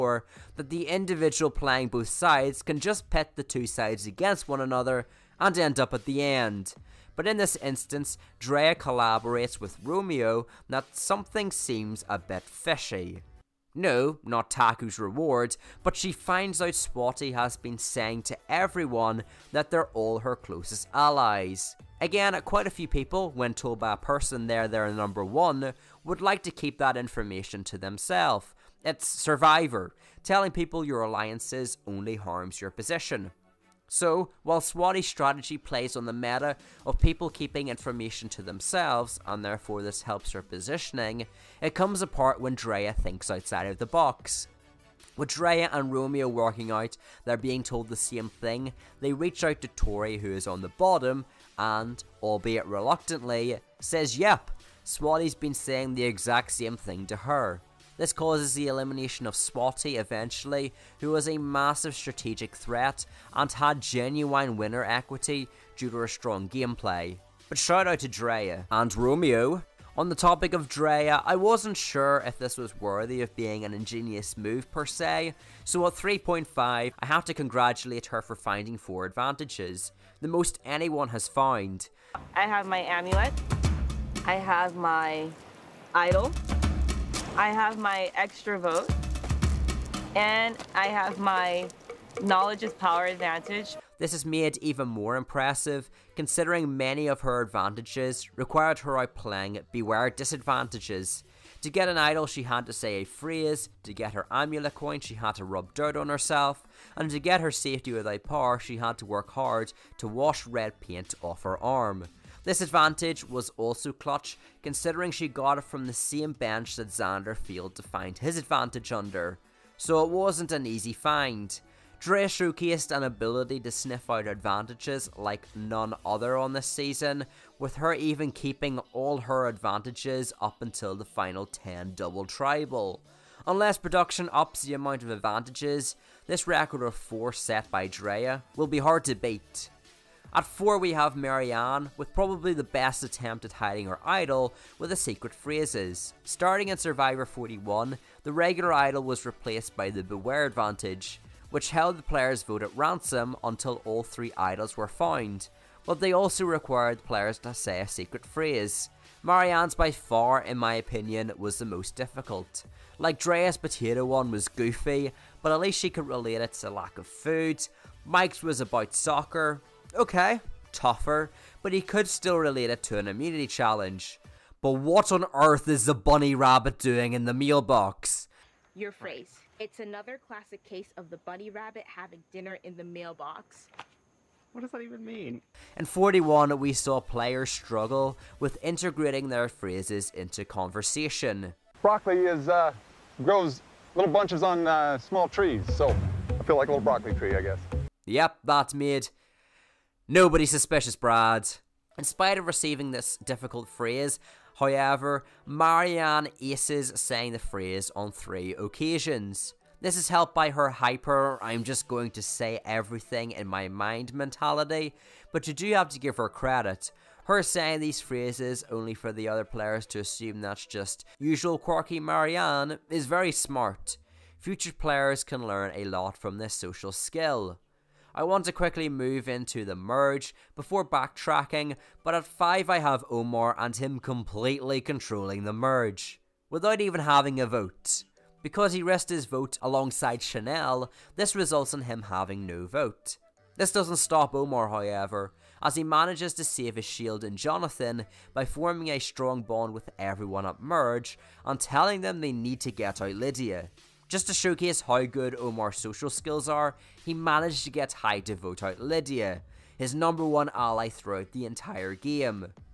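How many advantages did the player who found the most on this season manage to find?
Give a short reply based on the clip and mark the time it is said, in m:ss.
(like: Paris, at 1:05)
4, at 1:18.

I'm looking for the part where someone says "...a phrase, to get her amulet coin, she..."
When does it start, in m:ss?
1:42.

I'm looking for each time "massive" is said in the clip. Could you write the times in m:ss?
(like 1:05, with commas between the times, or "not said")
1:01.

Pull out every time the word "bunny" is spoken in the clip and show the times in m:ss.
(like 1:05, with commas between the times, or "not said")
2:55, 3:01.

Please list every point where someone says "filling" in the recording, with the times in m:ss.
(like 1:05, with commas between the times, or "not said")
not said.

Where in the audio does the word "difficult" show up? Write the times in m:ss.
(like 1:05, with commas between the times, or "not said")
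2:41, 3:23.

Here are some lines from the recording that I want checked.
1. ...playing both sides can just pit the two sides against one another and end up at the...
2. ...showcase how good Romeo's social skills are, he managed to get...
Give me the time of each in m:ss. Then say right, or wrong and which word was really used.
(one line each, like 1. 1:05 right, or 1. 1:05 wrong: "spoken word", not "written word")
1. 0:01 right
2. 4:14 wrong: "Omar", not "Romeo".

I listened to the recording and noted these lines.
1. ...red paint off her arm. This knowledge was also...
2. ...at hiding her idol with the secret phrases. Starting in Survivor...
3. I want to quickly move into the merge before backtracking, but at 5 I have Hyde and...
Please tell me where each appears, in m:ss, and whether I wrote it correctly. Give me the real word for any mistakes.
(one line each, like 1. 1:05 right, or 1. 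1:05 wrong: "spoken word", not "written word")
1. 1:50 wrong: "advantage", not "knowledge"
2. 2:23 right
3. 3:48 wrong: "Omar", not "Hyde".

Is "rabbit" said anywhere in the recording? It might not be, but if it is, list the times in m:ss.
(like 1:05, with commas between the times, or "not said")
2:56, 3:01.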